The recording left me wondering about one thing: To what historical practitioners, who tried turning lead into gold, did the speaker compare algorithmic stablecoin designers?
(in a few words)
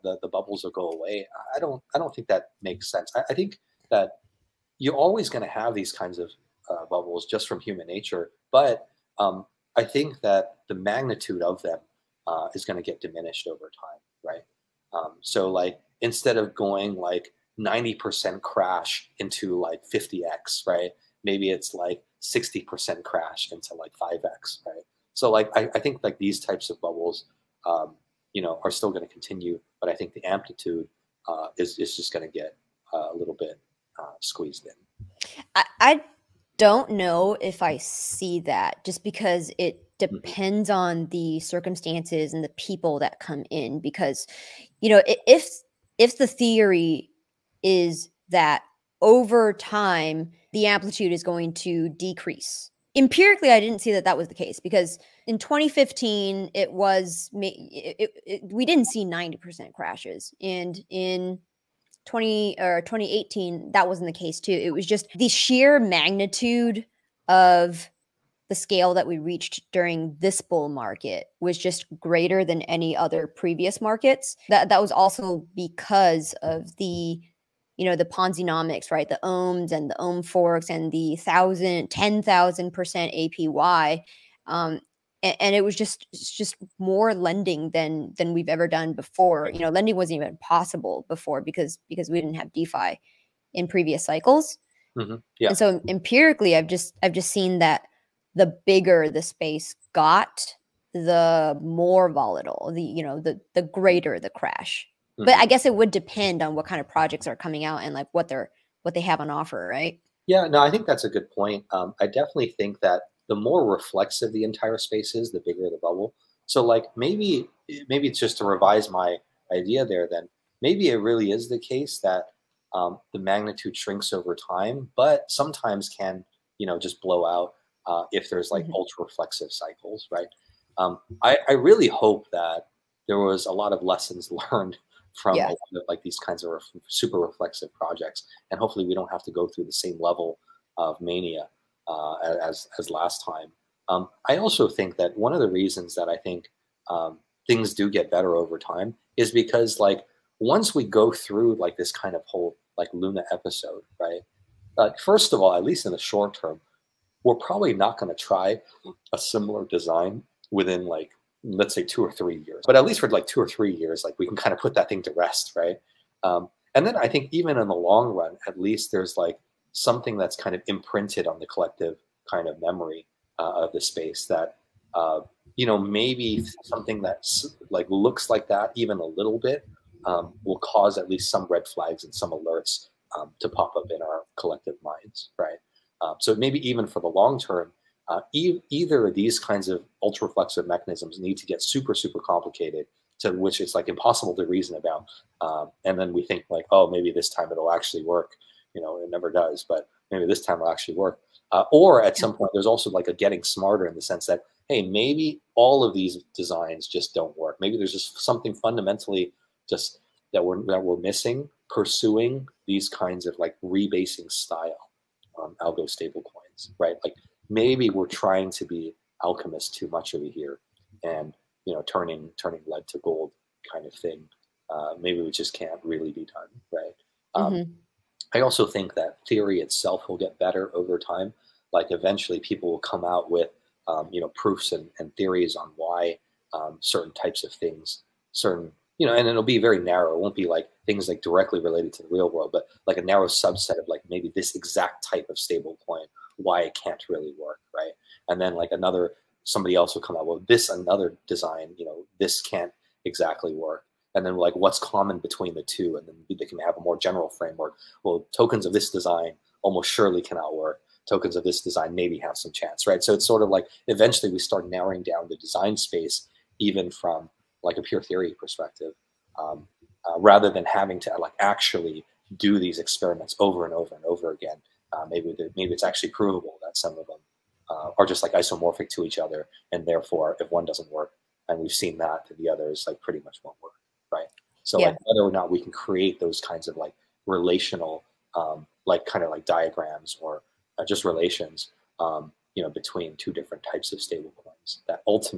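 Alchemists.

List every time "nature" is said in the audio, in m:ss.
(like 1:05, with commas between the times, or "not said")
0:07.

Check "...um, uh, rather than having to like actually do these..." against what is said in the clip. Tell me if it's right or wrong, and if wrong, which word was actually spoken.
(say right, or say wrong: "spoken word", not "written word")
right.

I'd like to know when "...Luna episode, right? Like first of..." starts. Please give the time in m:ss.
2:32.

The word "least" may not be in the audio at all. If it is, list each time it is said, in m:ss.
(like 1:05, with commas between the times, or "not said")
2:35, 2:42, 2:48, 3:01.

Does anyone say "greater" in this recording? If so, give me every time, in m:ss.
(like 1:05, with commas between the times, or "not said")
1:11, 1:43.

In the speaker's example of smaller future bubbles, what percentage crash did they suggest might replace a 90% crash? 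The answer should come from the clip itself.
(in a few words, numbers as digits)
60%.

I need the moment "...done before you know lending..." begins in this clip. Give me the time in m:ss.
1:28.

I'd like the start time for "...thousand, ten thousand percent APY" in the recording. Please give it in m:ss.
1:21.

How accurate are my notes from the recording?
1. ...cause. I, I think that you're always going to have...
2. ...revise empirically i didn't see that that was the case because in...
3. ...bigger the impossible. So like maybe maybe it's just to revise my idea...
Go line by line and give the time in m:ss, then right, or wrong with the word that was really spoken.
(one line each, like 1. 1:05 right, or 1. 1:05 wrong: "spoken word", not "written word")
1. 0:02 wrong: "sense", not "cause"
2. 0:51 wrong: "decrease", not "revise"
3. 1:55 wrong: "bubble", not "impossible".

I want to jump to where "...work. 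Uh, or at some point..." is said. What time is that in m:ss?
3:20.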